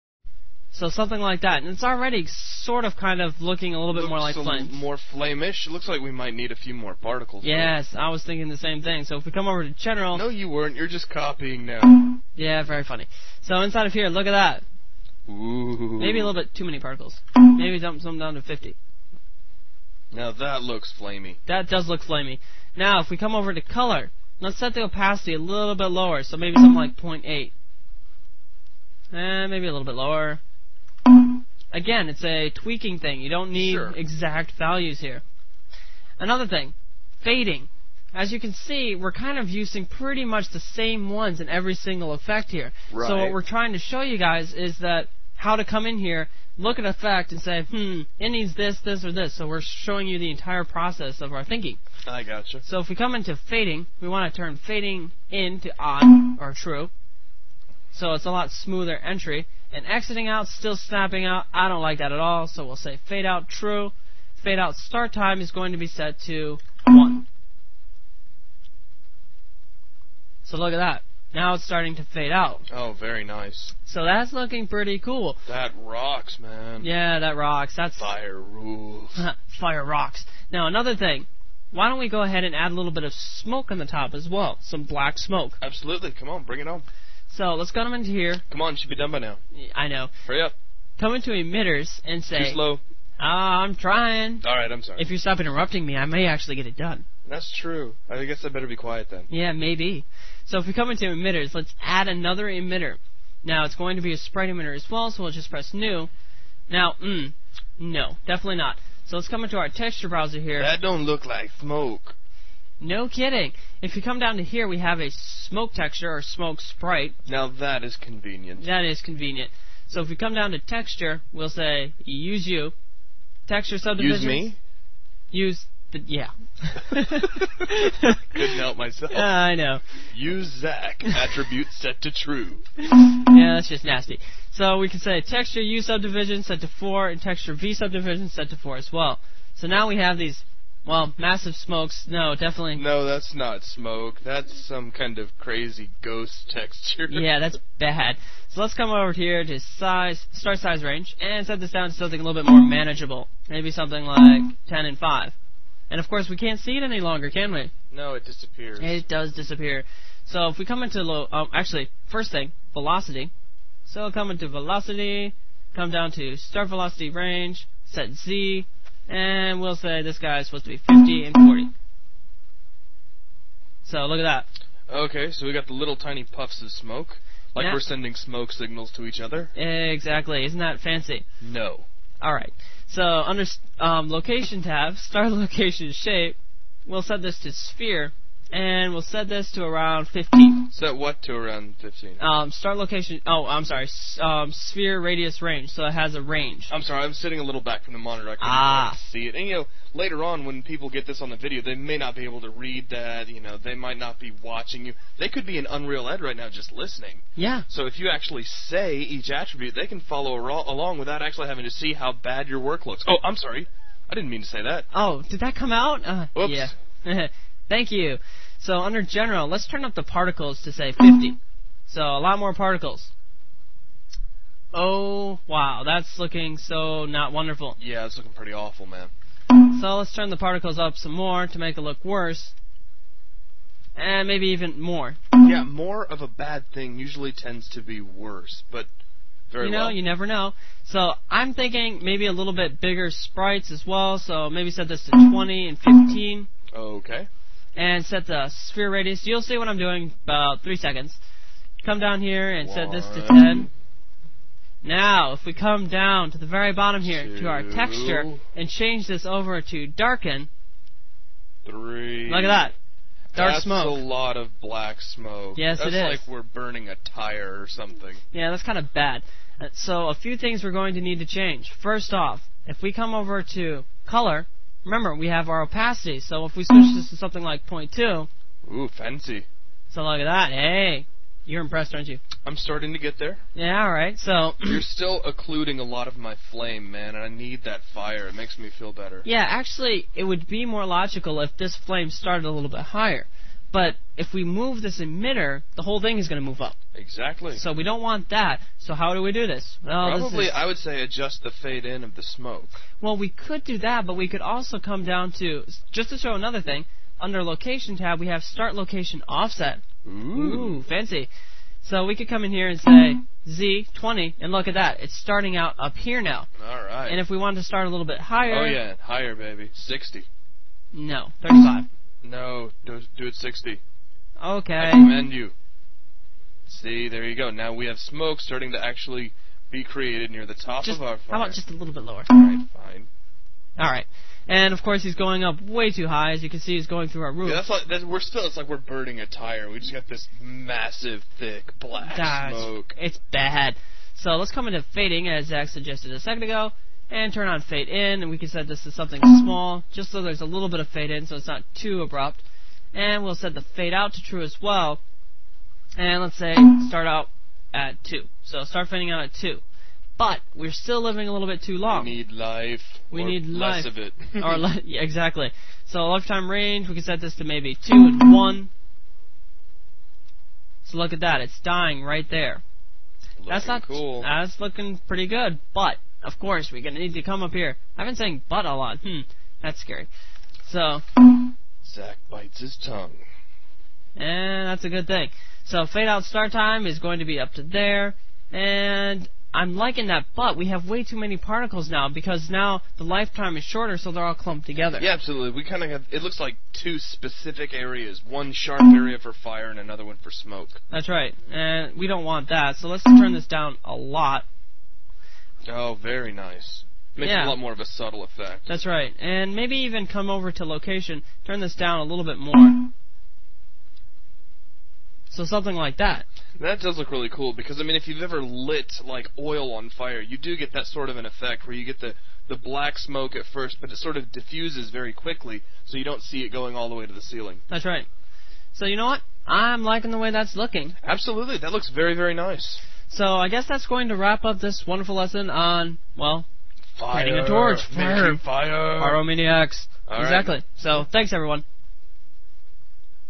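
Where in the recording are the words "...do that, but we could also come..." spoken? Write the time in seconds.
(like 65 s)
303 s.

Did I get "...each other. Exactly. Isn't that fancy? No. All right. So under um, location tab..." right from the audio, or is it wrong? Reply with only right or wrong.
right.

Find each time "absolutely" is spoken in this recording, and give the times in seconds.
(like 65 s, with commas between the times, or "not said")
85 s, 395 s, 431 s.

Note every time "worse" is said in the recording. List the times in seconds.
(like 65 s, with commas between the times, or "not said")
232 s, 238 s.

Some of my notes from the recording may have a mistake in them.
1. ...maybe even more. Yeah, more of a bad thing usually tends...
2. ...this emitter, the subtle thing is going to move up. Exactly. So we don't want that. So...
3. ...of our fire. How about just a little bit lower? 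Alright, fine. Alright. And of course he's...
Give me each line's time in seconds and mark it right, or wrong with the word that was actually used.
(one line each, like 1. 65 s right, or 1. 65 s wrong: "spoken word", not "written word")
1. 234 s right
2. 294 s wrong: "whole", not "subtle"
3. 330 s right.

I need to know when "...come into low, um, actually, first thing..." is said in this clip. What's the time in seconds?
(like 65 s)
160 s.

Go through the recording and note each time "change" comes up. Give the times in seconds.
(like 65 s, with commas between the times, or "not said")
258 s, 271 s.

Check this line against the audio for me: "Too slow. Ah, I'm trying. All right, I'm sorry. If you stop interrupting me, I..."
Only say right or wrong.
right.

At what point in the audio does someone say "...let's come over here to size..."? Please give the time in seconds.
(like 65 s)
148 s.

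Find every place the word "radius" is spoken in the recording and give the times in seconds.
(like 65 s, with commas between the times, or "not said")
195 s, 248 s.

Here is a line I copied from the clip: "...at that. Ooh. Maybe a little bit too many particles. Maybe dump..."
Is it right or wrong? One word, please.
right.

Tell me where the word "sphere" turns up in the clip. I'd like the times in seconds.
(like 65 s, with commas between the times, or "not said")
187 s, 194 s, 248 s.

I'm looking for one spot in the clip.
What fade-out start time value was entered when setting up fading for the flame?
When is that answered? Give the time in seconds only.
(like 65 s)
64 s.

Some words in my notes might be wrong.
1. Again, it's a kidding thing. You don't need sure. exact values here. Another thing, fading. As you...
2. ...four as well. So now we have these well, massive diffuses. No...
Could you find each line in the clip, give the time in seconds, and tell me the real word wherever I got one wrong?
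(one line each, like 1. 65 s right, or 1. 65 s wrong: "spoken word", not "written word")
1. 31 s wrong: "tweaking", not "kidding"
2. 138 s wrong: "smokes", not "diffuses".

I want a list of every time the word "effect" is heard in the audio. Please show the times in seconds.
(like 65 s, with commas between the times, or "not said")
42 s, 46 s, 408 s, 421 s.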